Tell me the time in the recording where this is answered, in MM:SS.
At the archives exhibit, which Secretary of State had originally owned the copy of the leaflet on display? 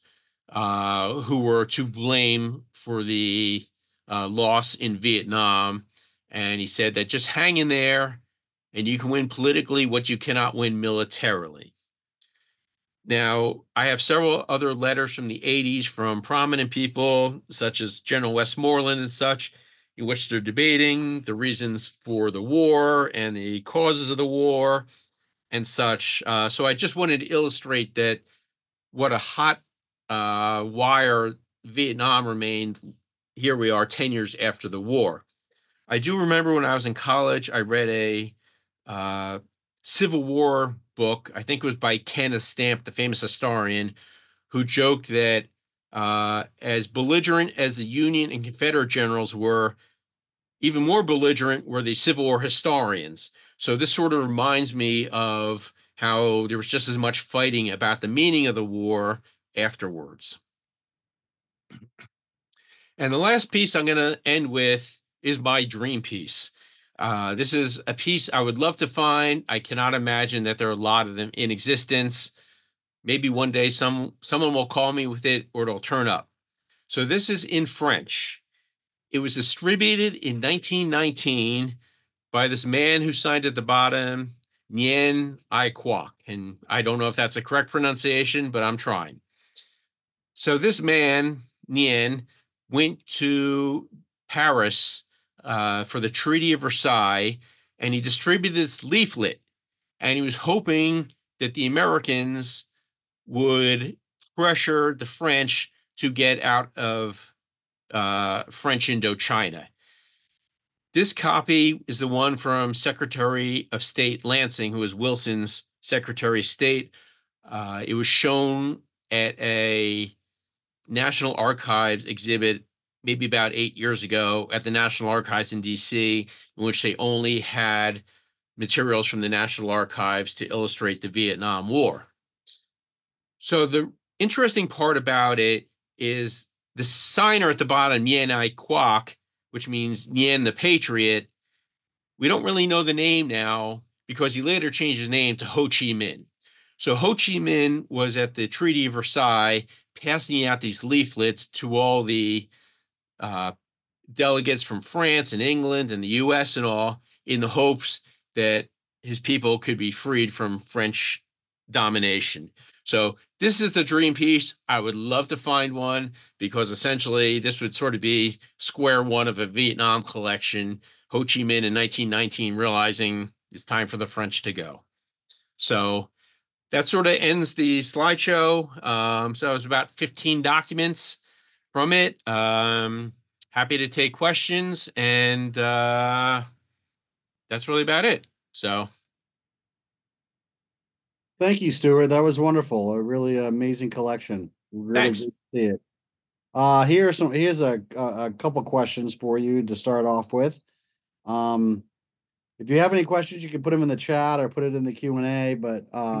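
01:54.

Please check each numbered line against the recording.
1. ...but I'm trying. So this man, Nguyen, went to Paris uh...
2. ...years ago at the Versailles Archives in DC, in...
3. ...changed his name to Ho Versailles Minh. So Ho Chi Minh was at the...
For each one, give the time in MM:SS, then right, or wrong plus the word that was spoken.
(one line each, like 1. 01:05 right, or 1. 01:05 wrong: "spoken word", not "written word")
1. 01:28 right
2. 02:03 wrong: "National", not "Versailles"
3. 02:24 wrong: "Chi", not "Versailles".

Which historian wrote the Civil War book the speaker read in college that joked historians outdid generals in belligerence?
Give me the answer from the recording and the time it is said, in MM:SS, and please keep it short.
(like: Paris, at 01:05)
Kenneth Stampp, at 00:41.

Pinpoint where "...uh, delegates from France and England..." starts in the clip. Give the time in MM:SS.
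02:33.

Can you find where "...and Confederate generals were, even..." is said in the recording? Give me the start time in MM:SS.
00:48.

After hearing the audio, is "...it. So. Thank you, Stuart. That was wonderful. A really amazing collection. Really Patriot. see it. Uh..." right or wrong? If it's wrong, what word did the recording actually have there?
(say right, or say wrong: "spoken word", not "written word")
wrong: "Thanks", not "Patriot".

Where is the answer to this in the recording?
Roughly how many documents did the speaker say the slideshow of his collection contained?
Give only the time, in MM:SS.
02:59.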